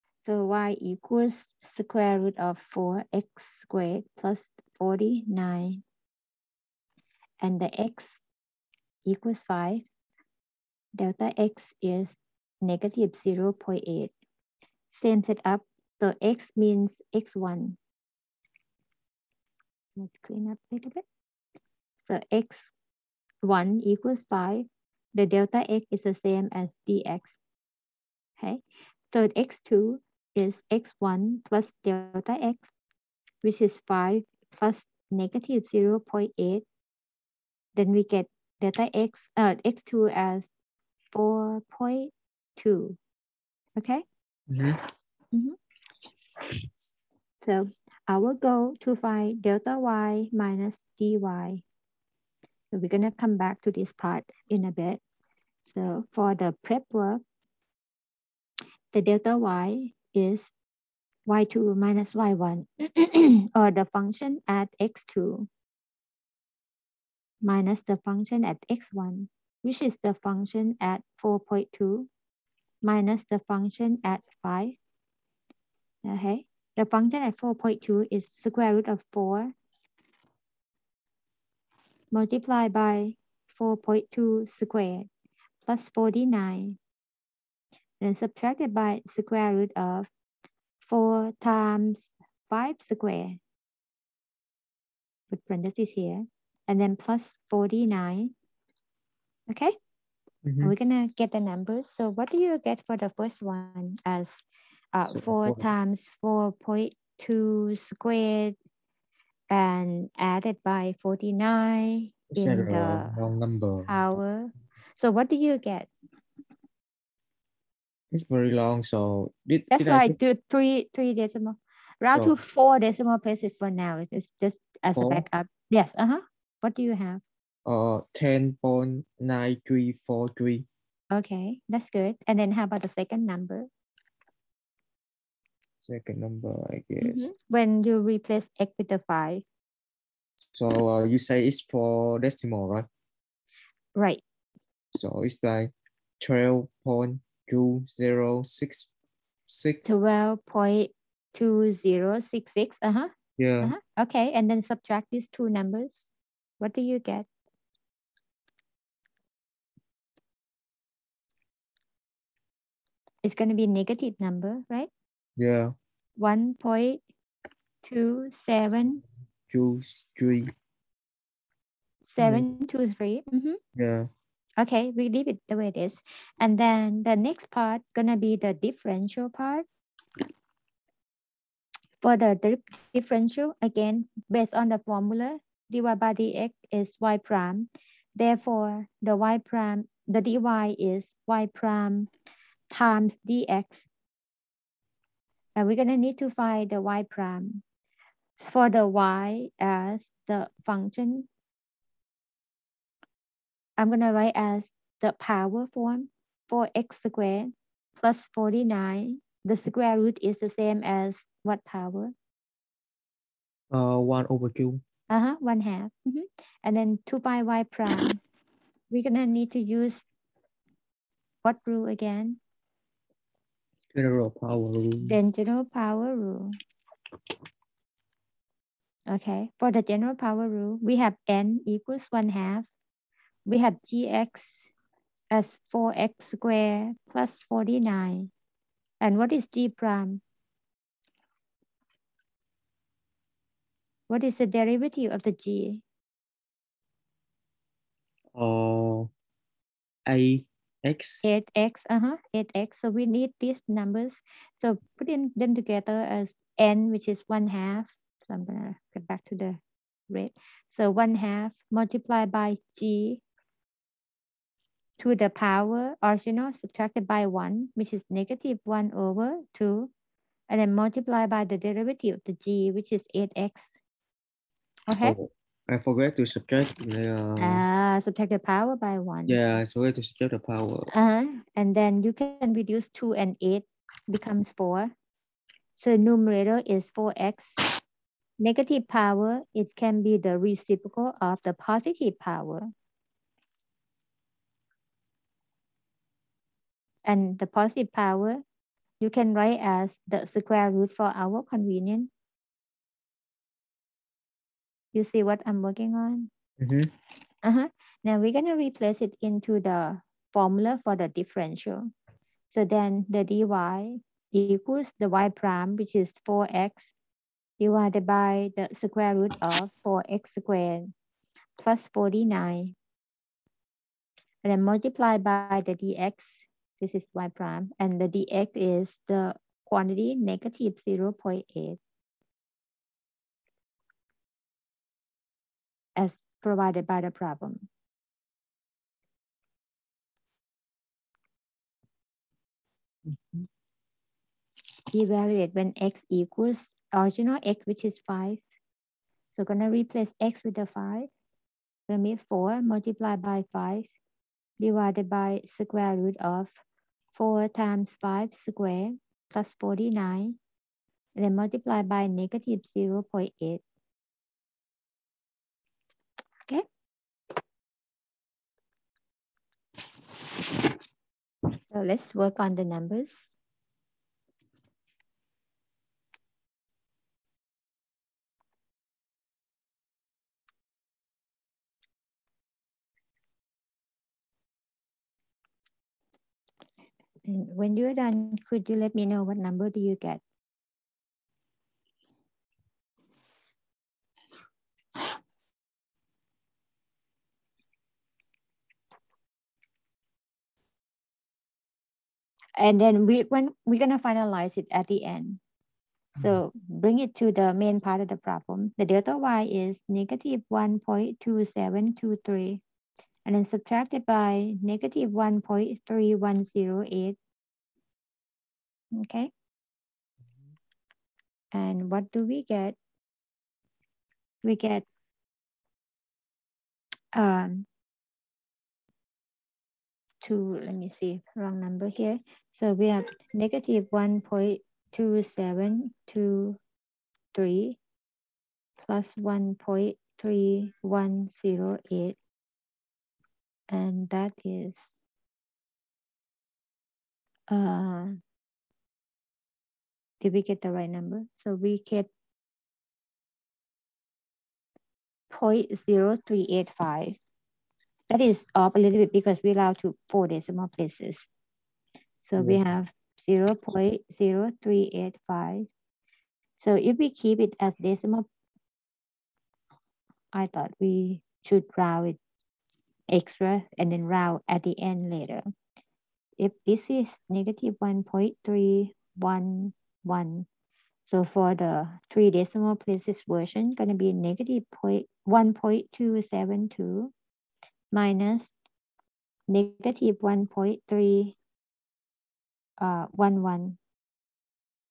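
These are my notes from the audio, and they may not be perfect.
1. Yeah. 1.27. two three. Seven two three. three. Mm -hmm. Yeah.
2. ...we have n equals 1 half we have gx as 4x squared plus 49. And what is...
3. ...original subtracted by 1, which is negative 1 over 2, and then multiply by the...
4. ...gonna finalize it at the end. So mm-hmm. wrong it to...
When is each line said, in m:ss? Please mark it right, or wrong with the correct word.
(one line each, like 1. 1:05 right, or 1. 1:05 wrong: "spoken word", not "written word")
1. 2:45 right
2. 3:50 right
3. 4:26 right
4. 6:43 wrong: "bring", not "wrong".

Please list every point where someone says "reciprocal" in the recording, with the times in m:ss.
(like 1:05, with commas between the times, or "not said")
4:50.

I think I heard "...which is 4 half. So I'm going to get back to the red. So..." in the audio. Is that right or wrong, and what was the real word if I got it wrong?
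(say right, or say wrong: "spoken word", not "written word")
wrong: "1", not "4".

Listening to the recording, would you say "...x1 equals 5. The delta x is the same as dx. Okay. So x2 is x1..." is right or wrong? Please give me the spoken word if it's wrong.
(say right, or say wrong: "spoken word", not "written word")
right.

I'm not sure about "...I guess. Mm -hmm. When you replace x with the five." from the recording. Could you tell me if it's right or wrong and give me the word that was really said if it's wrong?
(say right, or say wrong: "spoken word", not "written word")
right.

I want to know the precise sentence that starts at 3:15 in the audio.
And we're gonna need to find the y prime.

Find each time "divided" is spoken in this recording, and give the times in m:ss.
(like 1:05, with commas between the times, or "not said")
5:17, 5:54.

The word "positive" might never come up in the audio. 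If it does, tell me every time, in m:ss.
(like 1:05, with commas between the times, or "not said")
4:51, 4:57.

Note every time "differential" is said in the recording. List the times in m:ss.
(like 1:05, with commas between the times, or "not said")
2:58, 3:02, 5:11.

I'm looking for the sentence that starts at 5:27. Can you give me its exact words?
And the dx is the quantity negative 0 0.8 as provided by the problem.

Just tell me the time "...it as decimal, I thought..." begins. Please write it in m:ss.
7:47.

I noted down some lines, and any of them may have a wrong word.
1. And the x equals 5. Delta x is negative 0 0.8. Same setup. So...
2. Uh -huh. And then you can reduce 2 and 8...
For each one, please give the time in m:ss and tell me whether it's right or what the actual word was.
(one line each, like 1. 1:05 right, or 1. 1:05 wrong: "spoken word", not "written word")
1. 0:07 right
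2. 4:40 right.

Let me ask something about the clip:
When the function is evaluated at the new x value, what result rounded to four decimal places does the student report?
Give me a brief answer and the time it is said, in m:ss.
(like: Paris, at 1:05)
10.9343, at 2:08.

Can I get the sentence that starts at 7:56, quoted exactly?
If this is negative 1.311, so for the three decimal places version, gonna be negative 1.272 minus negative 1.311.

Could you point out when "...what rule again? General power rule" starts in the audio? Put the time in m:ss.
3:41.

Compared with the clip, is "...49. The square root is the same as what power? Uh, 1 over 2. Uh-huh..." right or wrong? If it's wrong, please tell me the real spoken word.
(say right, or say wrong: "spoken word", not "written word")
right.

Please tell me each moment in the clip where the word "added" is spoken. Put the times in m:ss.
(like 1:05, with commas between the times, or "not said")
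1:50.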